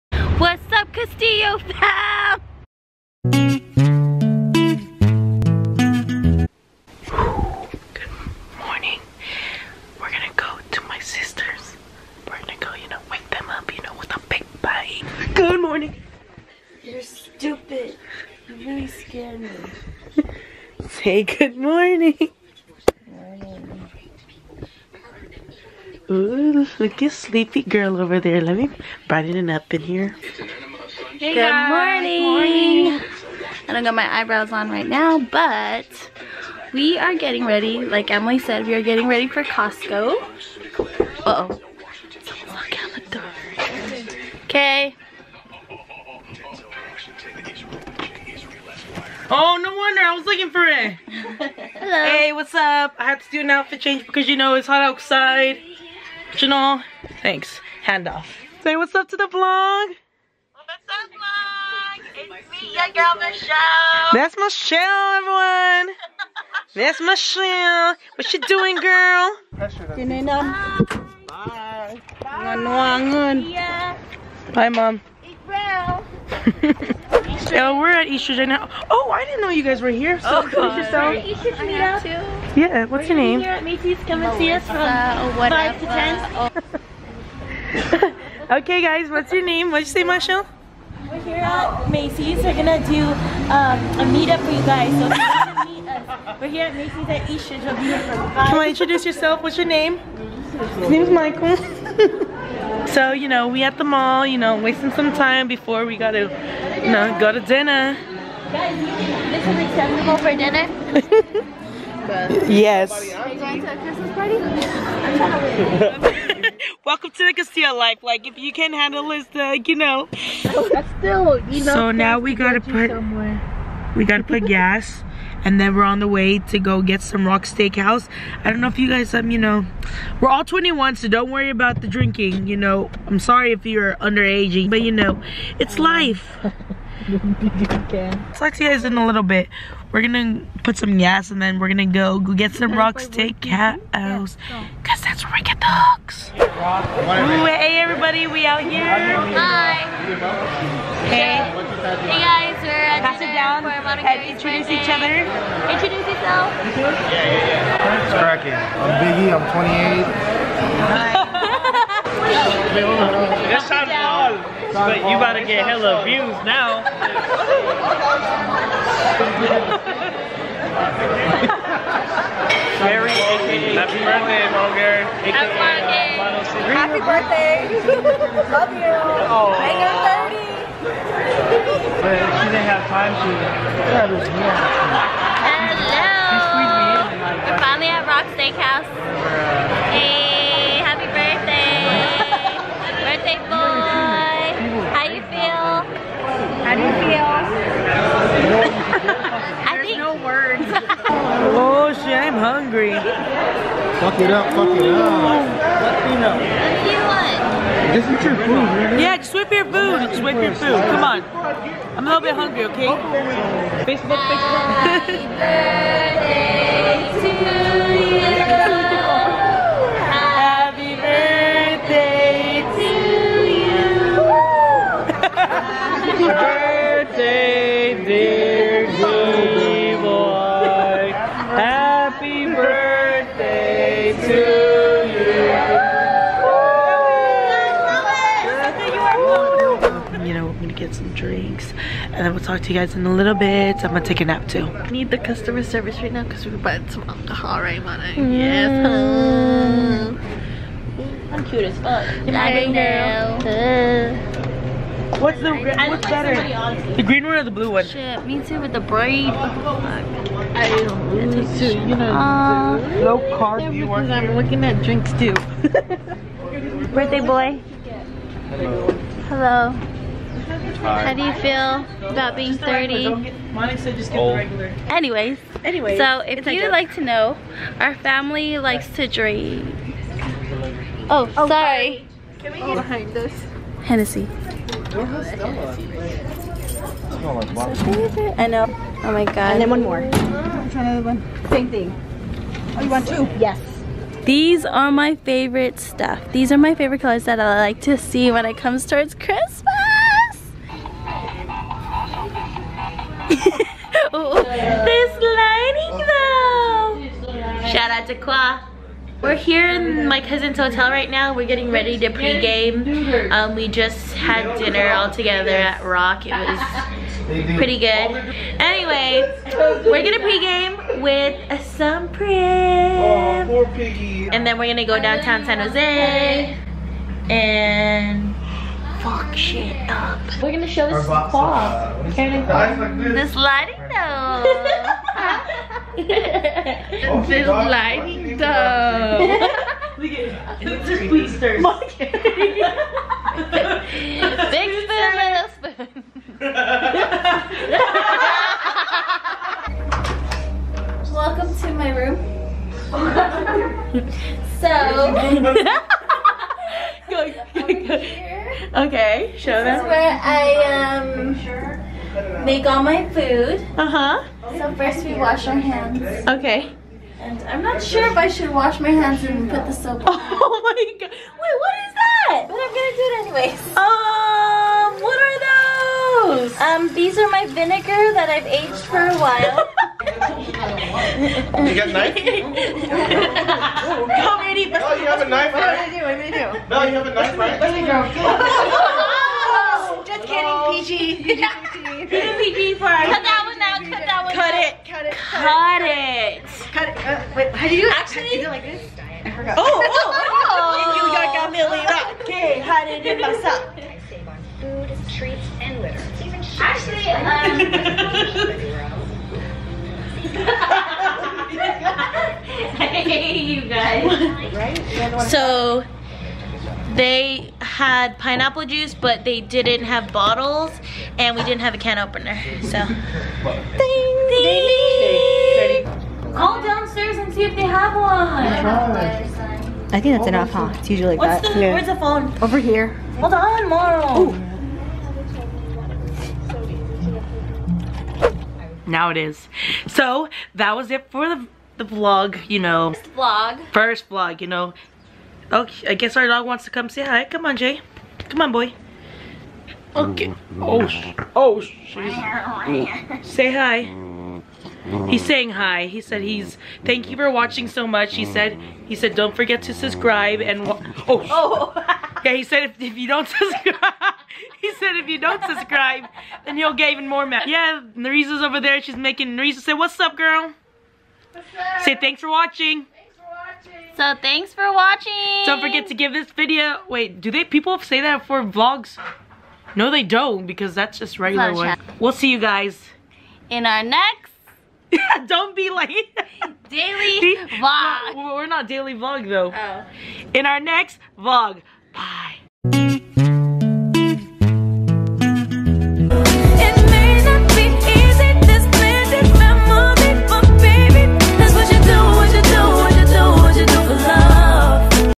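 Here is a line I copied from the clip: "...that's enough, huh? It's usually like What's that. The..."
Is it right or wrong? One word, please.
right.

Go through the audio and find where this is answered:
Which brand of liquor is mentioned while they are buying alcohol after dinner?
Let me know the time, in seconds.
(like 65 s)
283 s.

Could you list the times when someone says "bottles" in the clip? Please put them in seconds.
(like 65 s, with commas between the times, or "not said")
420 s.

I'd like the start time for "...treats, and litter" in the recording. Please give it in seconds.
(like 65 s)
405 s.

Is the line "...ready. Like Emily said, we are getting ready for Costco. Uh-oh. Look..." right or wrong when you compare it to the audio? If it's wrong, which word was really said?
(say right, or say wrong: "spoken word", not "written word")
right.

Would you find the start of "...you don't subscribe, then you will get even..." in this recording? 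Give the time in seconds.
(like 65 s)
465 s.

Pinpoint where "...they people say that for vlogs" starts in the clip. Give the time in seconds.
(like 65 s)
477 s.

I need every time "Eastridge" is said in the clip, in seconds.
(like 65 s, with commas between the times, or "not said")
78 s, 97 s.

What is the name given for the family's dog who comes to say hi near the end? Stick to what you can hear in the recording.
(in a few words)
Jay.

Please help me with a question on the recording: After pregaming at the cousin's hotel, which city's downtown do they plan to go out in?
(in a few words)
San Jose.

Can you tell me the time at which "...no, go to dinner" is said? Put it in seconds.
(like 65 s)
106 s.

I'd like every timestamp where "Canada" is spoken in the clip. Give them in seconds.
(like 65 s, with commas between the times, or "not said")
not said.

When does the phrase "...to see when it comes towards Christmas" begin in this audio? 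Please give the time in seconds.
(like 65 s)
297 s.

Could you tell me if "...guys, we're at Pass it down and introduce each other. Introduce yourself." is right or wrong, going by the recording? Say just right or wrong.
right.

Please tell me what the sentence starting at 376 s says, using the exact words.
Um, these are my vinegar that I've aged for a while.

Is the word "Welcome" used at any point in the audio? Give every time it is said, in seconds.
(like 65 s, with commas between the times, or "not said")
116 s, 351 s.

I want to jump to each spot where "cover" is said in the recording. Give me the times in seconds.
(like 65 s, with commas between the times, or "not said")
not said.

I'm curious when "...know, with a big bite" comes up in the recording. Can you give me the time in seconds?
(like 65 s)
13 s.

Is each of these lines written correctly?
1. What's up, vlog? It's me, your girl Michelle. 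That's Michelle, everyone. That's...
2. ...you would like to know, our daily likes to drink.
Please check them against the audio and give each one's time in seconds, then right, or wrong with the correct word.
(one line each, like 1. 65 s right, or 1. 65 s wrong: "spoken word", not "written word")
1. 59 s right
2. 276 s wrong: "family", not "daily".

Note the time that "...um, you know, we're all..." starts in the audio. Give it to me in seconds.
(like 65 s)
129 s.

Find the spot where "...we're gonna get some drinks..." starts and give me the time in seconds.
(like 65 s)
240 s.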